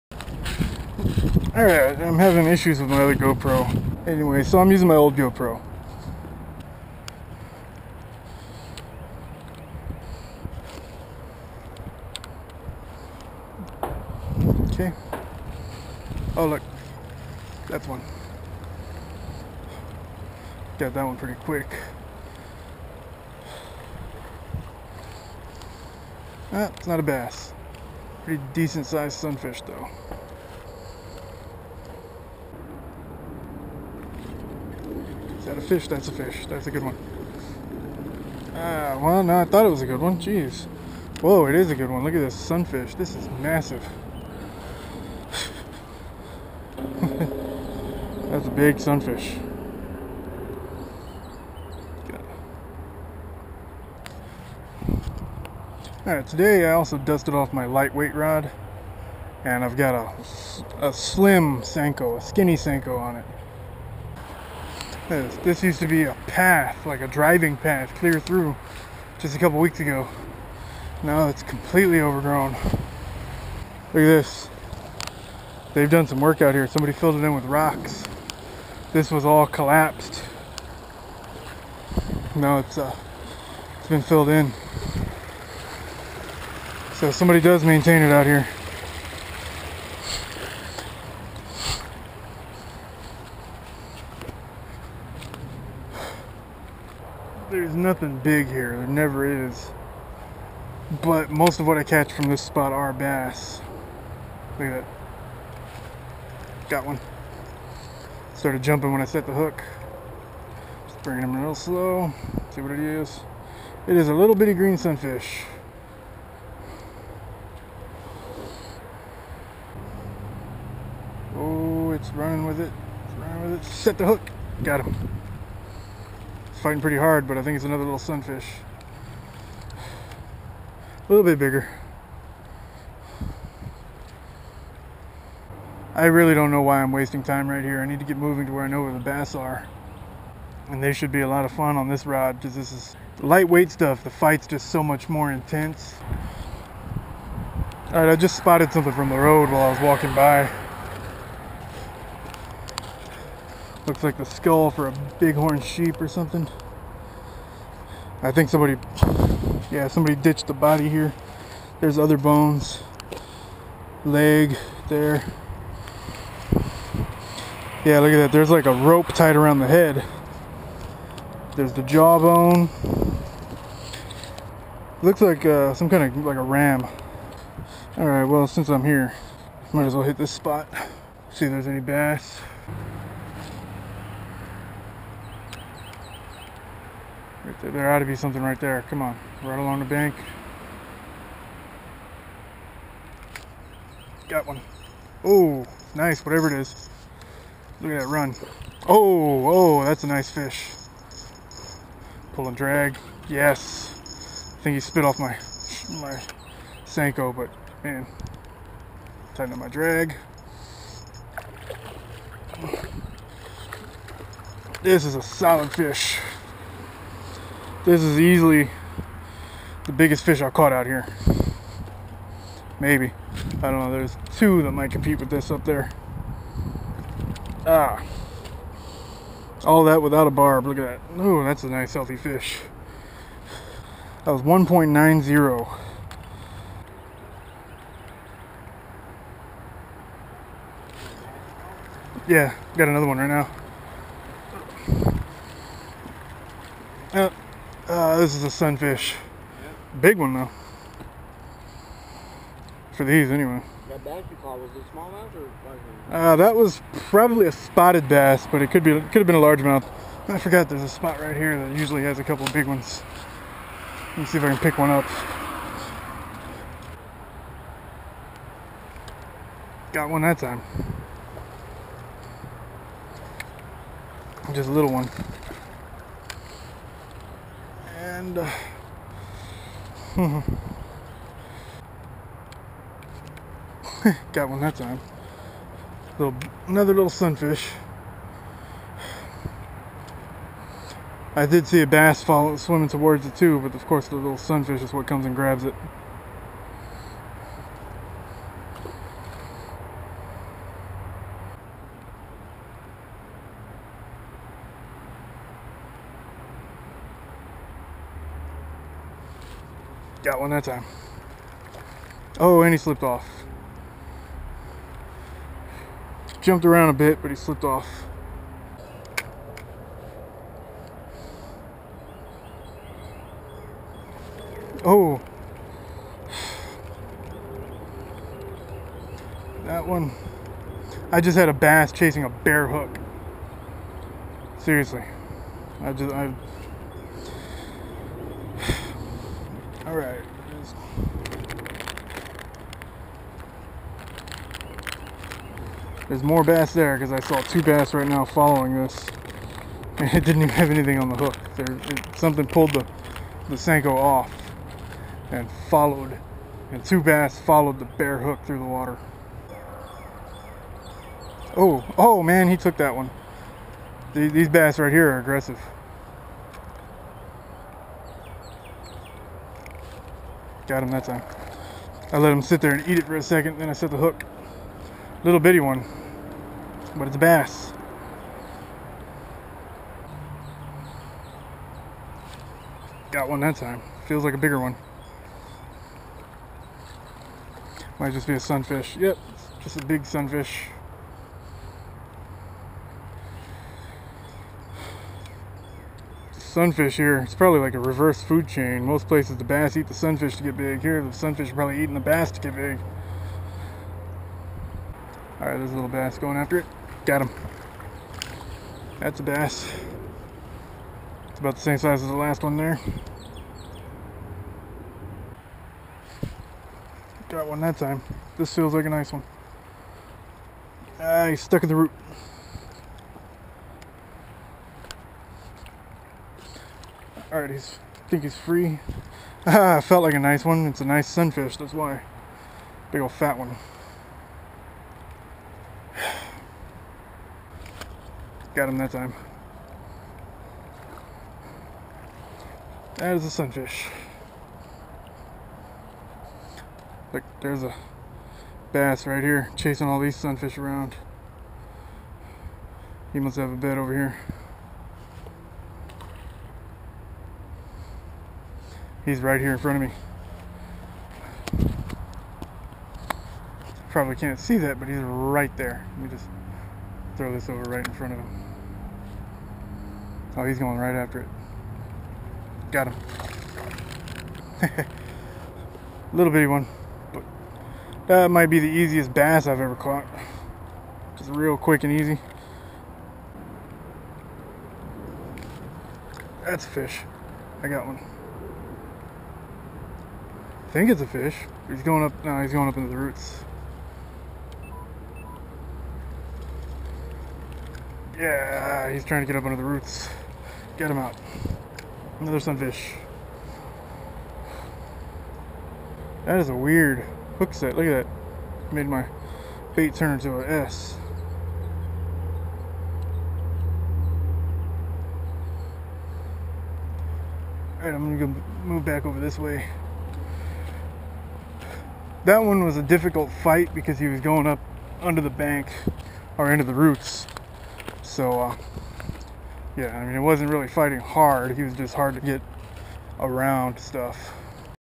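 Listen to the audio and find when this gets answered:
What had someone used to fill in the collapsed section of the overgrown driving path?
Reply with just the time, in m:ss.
1:17.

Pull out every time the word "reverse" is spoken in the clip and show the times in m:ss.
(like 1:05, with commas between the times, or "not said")
6:37.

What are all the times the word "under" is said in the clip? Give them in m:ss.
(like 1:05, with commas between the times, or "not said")
8:19, 8:45.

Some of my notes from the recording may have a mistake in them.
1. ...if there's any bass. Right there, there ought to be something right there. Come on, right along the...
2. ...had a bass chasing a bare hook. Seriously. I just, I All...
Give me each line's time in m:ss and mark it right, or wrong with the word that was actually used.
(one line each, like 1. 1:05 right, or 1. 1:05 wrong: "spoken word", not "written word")
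1. 3:01 right
2. 5:31 right.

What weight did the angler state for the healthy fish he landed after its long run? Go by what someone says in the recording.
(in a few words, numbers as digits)
1.90.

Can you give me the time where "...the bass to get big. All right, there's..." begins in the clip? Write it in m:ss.
6:41.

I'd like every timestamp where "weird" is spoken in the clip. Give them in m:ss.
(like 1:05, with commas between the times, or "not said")
8:26.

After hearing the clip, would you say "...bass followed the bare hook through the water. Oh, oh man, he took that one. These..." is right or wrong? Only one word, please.
right.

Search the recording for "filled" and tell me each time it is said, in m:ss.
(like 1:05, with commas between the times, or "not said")
1:16, 1:24.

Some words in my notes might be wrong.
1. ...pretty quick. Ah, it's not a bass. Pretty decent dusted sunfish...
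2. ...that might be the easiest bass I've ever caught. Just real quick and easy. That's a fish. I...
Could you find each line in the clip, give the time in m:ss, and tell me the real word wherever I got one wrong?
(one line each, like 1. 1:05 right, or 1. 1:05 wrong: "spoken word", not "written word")
1. 0:21 wrong: "sized", not "dusted"
2. 7:58 right.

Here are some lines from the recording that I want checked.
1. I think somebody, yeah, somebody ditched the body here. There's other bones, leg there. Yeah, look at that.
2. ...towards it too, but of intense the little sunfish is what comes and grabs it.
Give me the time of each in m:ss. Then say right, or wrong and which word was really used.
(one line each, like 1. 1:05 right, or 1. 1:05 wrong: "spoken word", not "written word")
1. 2:38 right
2. 4:52 wrong: "course", not "intense".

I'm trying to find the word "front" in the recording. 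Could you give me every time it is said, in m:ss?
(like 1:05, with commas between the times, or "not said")
7:39, 7:47.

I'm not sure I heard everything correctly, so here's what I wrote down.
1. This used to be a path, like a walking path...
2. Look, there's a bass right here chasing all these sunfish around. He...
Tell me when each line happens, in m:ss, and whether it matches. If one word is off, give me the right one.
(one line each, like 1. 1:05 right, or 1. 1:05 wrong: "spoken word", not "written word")
1. 1:05 wrong: "driving", not "walking"
2. 7:27 right.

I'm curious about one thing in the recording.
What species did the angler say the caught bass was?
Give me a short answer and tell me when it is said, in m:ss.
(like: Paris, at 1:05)
spotted bass, at 4:17.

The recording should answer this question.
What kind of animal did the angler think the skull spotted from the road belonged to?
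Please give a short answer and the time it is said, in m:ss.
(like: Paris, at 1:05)
bighorn sheep, at 2:35.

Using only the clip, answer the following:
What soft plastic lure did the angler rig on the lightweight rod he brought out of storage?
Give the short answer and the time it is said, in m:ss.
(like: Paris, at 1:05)
skinny Senko, at 1:02.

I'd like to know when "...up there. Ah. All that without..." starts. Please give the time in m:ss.
3:45.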